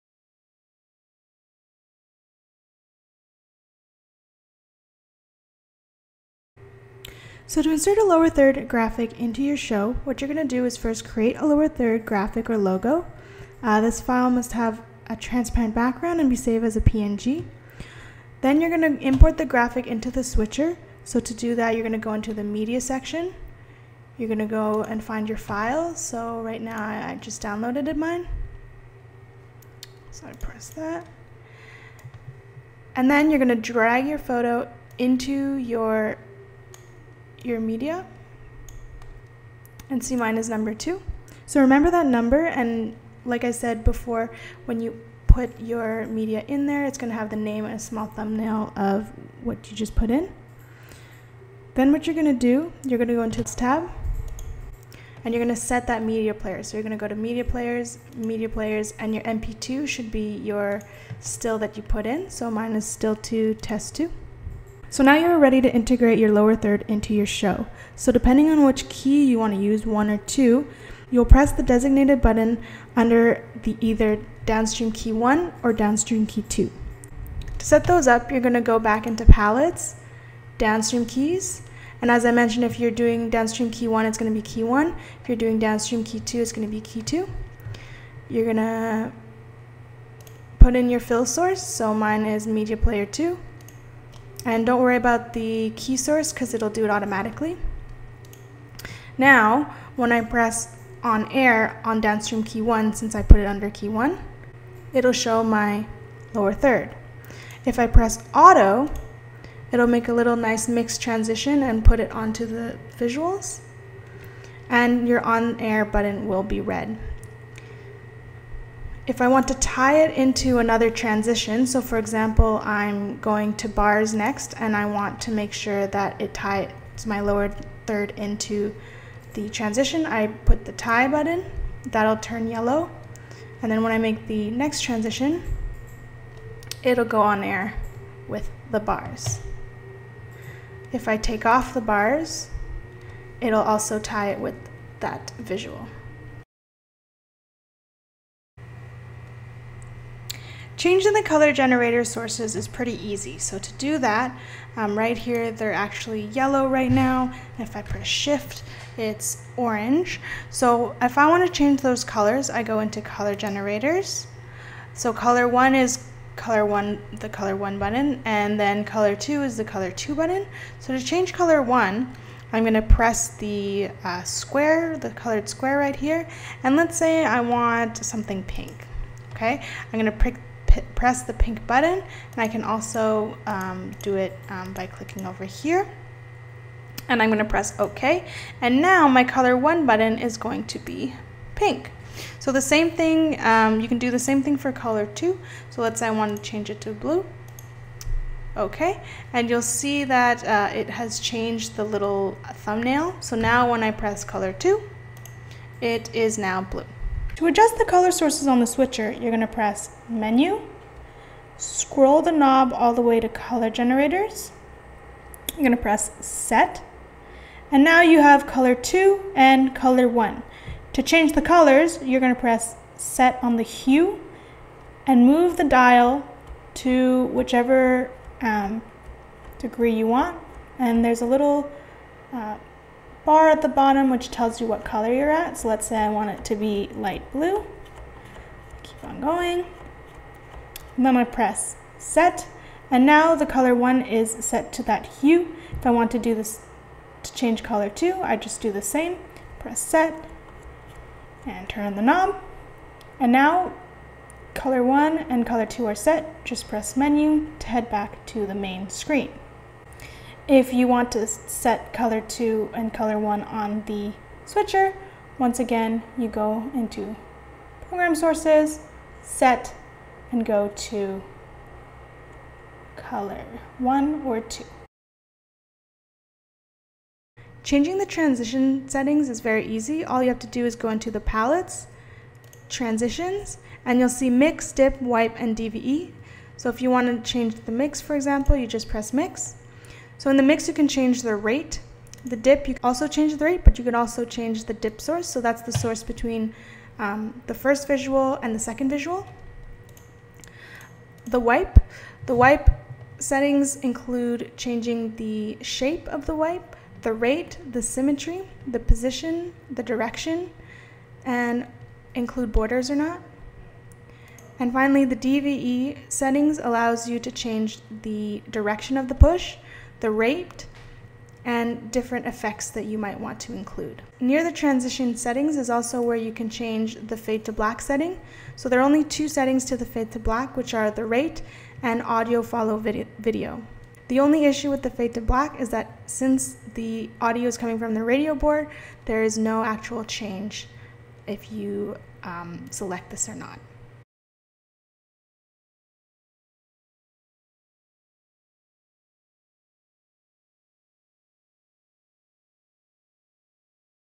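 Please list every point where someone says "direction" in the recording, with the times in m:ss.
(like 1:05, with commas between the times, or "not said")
5:09, 5:18.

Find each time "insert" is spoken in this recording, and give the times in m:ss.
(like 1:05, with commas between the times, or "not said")
0:07.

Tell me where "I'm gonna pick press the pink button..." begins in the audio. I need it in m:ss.
2:59.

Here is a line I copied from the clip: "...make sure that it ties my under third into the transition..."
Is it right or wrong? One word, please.
wrong.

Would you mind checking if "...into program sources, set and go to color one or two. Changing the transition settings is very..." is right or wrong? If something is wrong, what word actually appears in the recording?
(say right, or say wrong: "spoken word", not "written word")
right.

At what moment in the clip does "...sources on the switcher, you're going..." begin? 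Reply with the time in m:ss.
3:28.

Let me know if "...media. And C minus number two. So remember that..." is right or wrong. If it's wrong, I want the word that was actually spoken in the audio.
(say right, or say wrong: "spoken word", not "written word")
right.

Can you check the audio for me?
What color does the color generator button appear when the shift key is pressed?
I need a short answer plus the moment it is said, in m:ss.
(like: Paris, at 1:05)
Orange, at 2:39.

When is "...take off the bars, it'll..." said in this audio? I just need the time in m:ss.
2:21.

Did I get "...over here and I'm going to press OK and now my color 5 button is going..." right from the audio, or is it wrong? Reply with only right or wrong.
wrong.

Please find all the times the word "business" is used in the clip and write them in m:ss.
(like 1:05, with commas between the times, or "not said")
not said.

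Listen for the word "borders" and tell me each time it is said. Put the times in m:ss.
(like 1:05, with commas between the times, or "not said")
5:12.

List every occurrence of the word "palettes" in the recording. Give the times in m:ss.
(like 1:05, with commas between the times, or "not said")
1:19, 4:41.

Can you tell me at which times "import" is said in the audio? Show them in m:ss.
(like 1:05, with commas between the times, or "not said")
0:19.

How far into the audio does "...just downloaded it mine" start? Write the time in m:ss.
0:27.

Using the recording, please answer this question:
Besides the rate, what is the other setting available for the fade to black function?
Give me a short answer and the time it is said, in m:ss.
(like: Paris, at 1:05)
Audio follow video, at 5:32.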